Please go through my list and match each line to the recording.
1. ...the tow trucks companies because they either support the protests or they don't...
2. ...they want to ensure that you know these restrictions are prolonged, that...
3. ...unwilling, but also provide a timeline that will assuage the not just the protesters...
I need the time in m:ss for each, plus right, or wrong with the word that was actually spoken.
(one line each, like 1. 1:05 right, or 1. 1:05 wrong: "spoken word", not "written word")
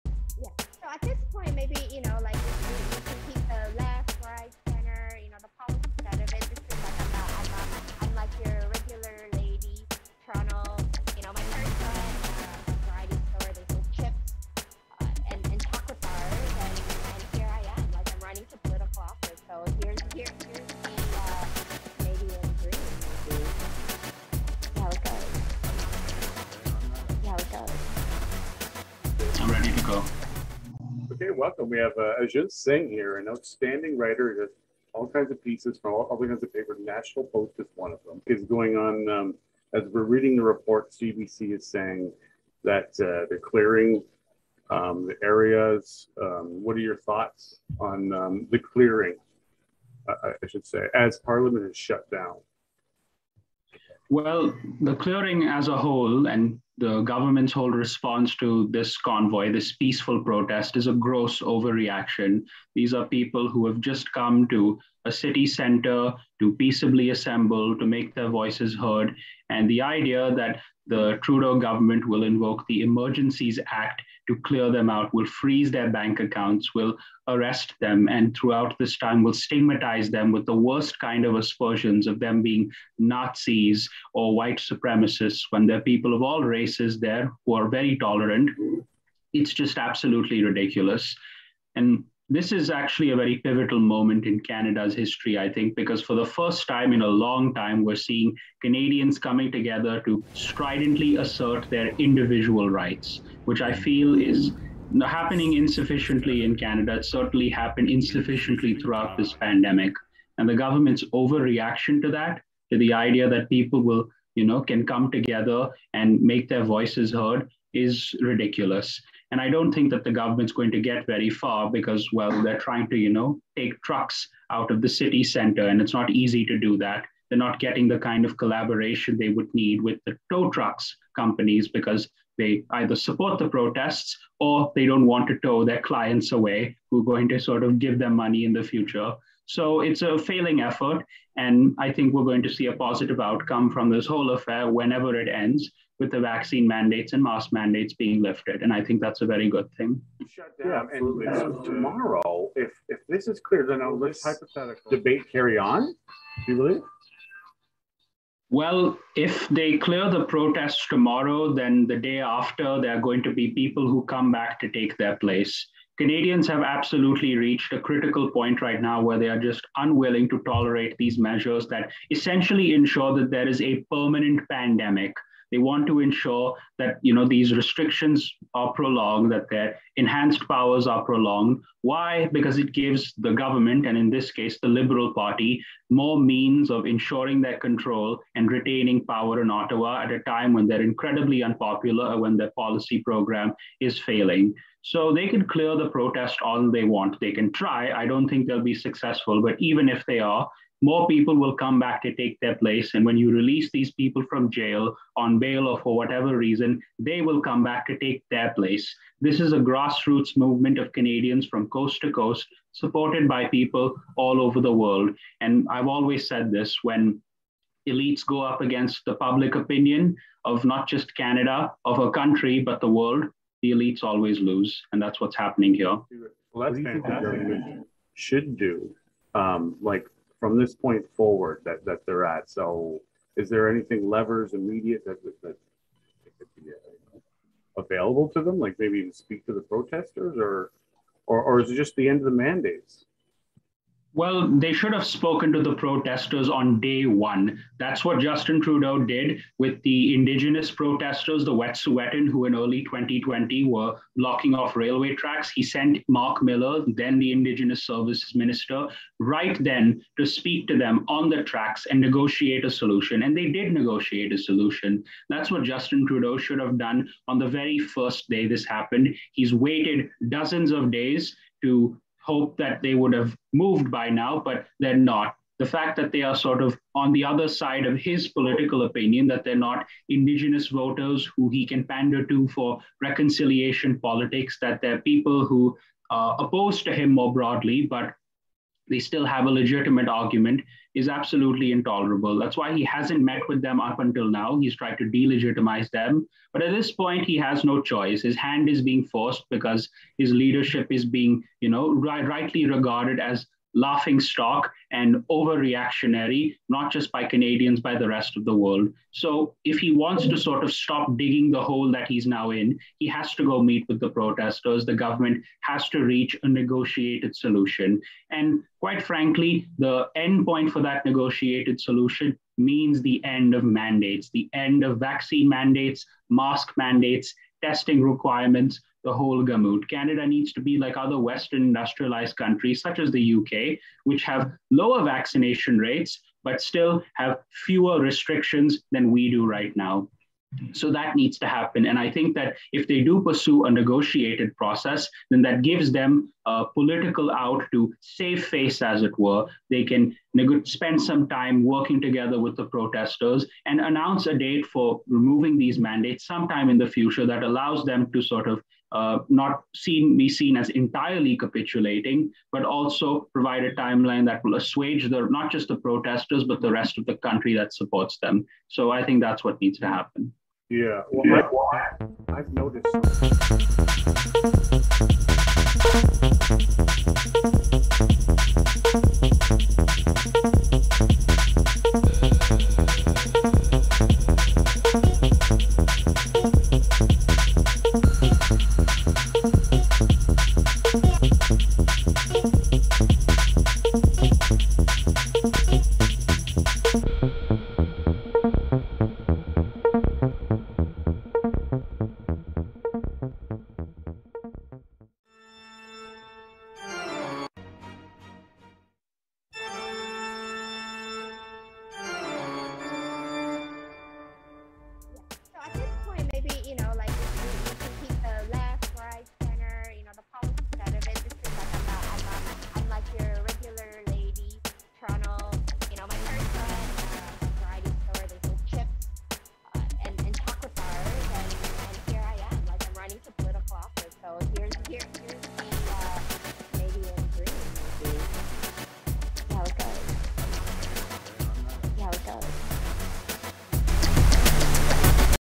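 1. 2:10 right
2. 2:55 right
3. 6:01 wrong: "capitulating", not "unwilling".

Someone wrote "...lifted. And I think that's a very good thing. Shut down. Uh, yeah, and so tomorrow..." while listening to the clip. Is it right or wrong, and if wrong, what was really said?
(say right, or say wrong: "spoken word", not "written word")
right.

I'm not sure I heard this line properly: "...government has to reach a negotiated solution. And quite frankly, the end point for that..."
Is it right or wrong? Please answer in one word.
right.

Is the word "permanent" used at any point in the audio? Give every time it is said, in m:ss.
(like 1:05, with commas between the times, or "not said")
2:53.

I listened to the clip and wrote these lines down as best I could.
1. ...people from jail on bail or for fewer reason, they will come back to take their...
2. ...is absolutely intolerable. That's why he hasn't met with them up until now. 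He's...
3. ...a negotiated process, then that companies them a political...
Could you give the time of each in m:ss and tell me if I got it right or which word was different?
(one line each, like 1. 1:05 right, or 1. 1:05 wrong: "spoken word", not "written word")
1. 3:23 wrong: "whatever", not "fewer"
2. 4:50 right
3. 5:43 wrong: "gives", not "companies".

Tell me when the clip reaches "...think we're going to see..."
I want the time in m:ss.
2:21.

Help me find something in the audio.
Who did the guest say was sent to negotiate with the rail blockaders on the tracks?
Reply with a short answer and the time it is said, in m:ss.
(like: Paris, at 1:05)
Mark Miller, at 4:16.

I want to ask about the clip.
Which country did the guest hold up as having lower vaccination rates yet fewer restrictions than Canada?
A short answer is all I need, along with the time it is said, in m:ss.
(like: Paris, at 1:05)
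UK, at 5:33.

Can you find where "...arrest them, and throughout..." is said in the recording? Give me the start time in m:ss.
1:17.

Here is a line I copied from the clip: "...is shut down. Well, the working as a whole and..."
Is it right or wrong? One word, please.
wrong.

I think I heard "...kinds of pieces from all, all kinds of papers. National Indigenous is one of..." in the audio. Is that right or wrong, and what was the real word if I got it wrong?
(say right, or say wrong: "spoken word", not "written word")
wrong: "Post", not "Indigenous".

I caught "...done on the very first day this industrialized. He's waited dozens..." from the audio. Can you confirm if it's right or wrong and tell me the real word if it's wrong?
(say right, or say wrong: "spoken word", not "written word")
wrong: "happened", not "industrialized".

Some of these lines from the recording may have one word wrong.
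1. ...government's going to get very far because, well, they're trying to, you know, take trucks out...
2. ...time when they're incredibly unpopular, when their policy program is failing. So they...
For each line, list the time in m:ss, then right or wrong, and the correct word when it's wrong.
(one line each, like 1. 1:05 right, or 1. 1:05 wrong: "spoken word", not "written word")
1. 2:00 right
2. 3:10 right.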